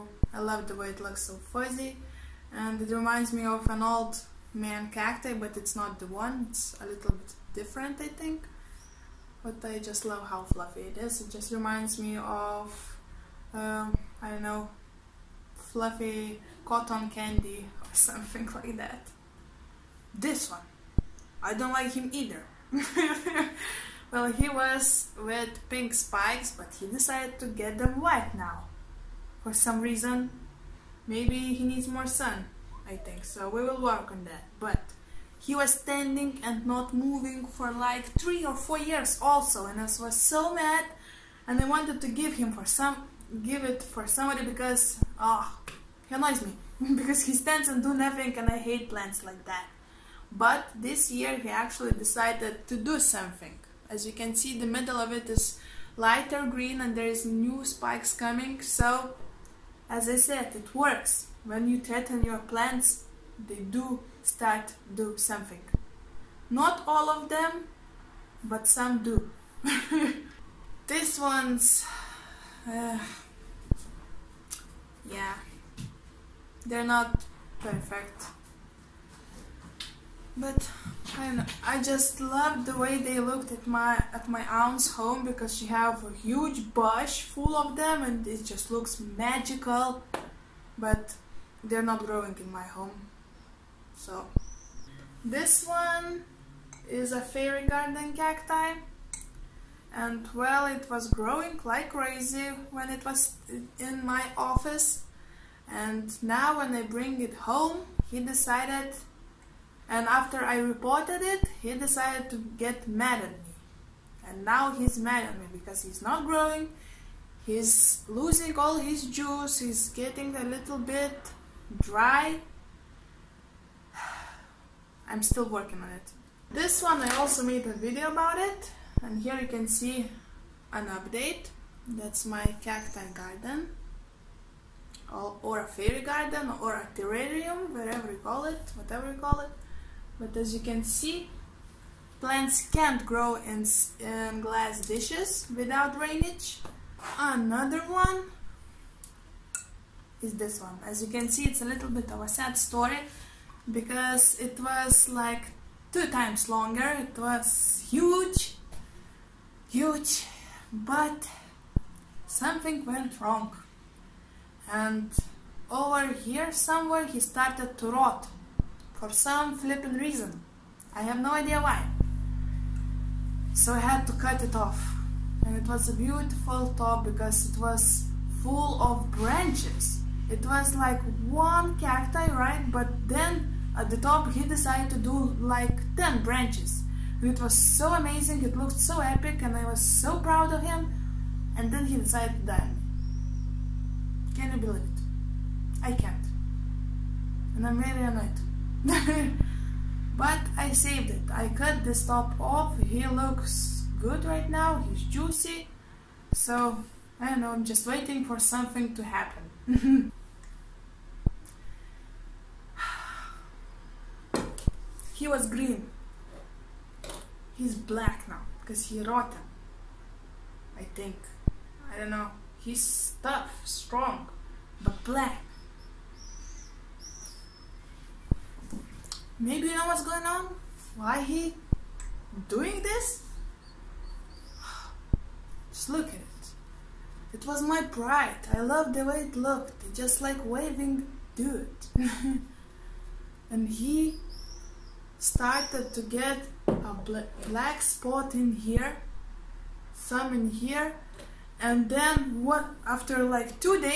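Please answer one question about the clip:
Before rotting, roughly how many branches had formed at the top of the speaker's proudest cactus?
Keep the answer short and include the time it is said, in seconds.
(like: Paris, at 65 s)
10, at 185 s.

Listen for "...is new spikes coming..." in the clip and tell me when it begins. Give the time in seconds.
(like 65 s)
57 s.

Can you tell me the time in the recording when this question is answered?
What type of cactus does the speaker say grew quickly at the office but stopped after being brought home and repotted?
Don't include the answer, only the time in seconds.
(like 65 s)
97 s.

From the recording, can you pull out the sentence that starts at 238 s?
I loved the way it looked.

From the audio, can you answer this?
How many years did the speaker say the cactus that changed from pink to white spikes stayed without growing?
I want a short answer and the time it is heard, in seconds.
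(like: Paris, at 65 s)
3 or 4 years, at 38 s.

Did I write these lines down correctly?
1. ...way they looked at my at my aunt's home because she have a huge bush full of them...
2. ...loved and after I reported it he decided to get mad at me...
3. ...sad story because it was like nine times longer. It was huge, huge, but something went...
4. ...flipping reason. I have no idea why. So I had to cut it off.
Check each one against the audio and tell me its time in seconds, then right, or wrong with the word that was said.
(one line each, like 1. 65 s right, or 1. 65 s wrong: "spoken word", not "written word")
1. 82 s right
2. 108 s wrong: "decided", not "loved"
3. 152 s wrong: "two", not "nine"
4. 169 s right.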